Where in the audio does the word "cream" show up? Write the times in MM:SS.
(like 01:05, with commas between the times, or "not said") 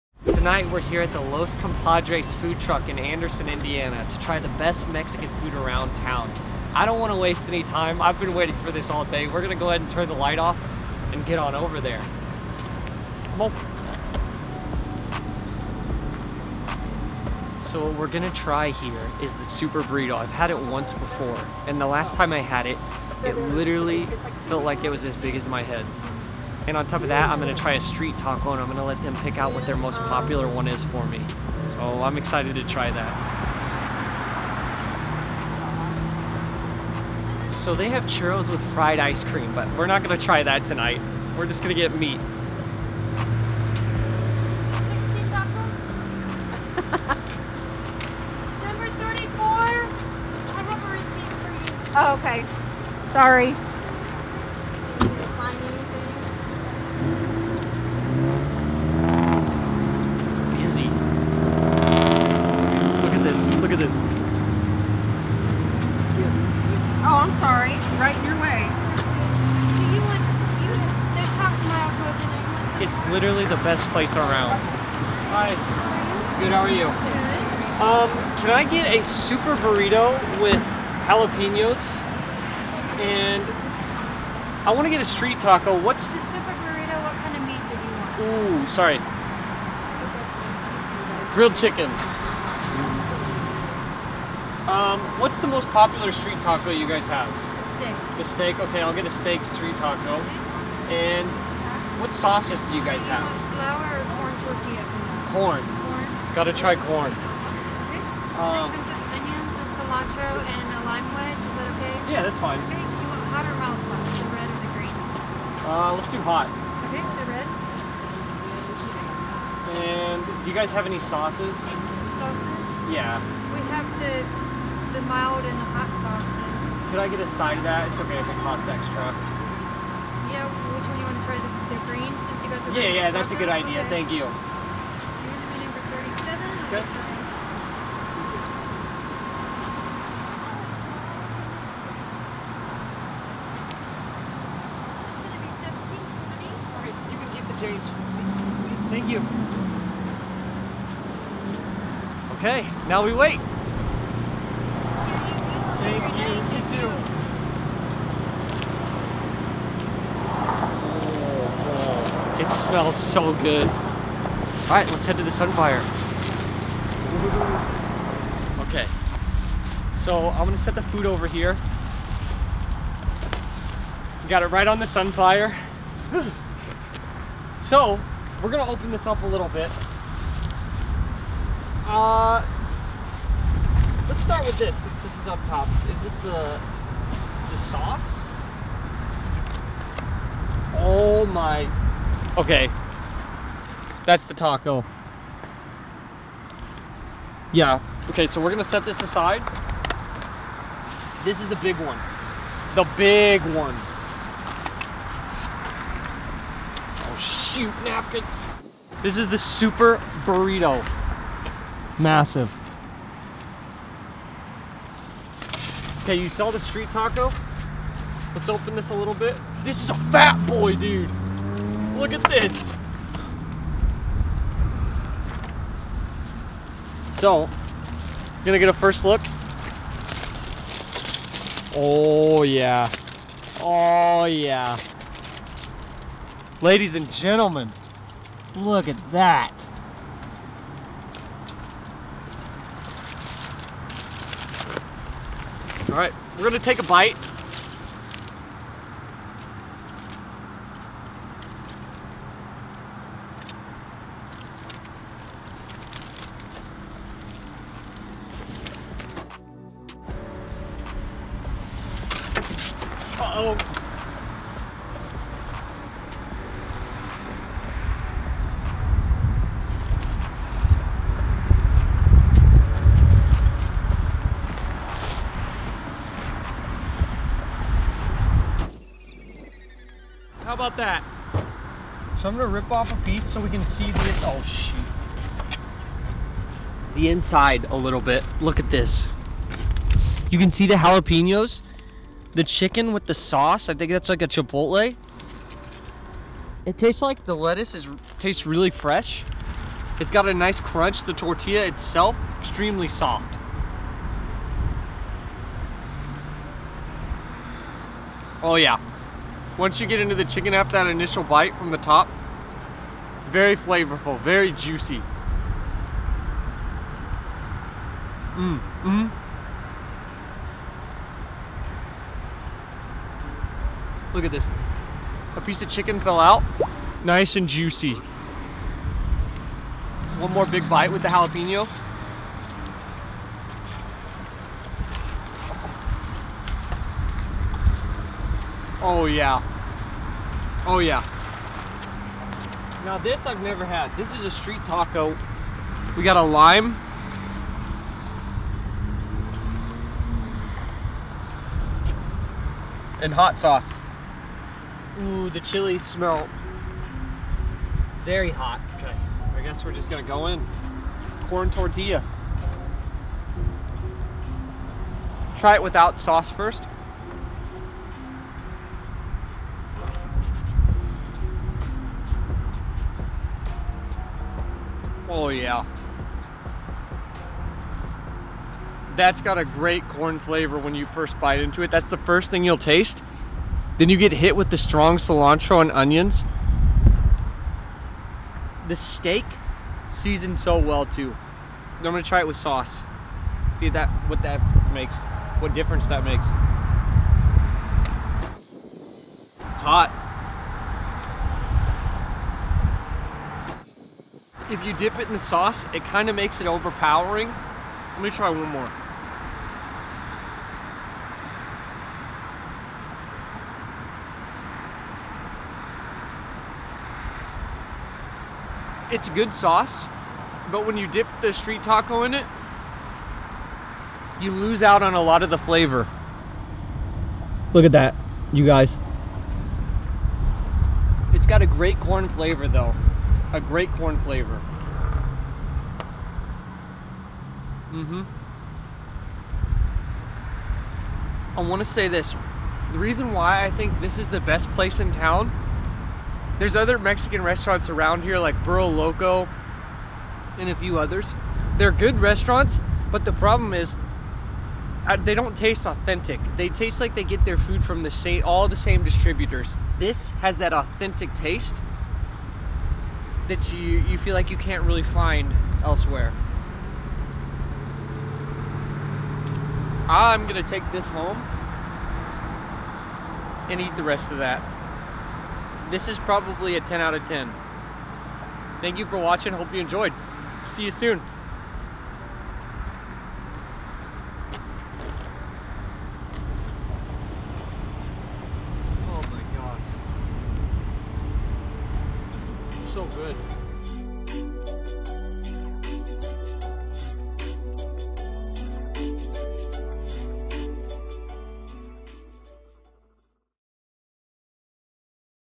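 00:39.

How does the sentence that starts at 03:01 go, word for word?
Uh, let's start with this since this is up top.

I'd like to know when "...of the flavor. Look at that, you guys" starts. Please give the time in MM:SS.
07:05.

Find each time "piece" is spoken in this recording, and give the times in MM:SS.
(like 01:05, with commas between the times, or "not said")
04:42, 05:25.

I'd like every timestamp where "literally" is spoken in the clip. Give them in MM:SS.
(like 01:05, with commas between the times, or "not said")
00:23, 01:13.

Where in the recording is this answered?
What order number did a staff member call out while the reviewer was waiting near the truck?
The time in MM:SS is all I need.
00:48.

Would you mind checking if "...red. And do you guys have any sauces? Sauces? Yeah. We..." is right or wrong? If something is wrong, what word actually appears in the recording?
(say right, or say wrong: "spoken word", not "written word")
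right.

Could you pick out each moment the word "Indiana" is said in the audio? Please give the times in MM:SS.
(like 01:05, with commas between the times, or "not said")
00:03.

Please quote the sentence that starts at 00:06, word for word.
I don't want to waste any time.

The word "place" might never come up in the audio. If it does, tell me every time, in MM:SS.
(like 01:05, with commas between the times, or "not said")
01:13, 07:24.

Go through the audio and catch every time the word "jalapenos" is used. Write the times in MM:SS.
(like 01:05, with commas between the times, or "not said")
01:21, 04:50, 05:31.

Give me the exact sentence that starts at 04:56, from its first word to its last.
It tastes like the lettuce is tastes really fresh.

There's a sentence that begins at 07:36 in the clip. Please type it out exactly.
They taste like they get their food from the same, all the same distributors.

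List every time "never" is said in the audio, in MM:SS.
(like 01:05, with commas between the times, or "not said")
05:43.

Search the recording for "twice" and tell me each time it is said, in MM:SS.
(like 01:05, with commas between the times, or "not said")
not said.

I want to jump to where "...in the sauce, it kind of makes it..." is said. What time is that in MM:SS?
06:45.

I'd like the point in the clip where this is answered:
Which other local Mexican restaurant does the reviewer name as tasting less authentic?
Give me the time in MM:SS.
07:28.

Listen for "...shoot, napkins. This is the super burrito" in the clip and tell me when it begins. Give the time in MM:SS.
03:27.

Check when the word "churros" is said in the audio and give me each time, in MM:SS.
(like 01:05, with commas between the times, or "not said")
00:38.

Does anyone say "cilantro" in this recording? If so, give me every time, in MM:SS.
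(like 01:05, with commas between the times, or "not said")
01:49, 06:24.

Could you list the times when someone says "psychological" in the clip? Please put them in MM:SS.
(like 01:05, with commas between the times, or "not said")
not said.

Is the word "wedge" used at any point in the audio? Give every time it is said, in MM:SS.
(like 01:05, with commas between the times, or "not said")
01:51.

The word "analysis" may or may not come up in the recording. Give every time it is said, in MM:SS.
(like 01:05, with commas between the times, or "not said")
not said.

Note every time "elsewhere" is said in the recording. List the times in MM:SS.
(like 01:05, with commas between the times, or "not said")
07:45.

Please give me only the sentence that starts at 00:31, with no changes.
So I'm excited to try that.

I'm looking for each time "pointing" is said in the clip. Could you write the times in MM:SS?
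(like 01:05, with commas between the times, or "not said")
not said.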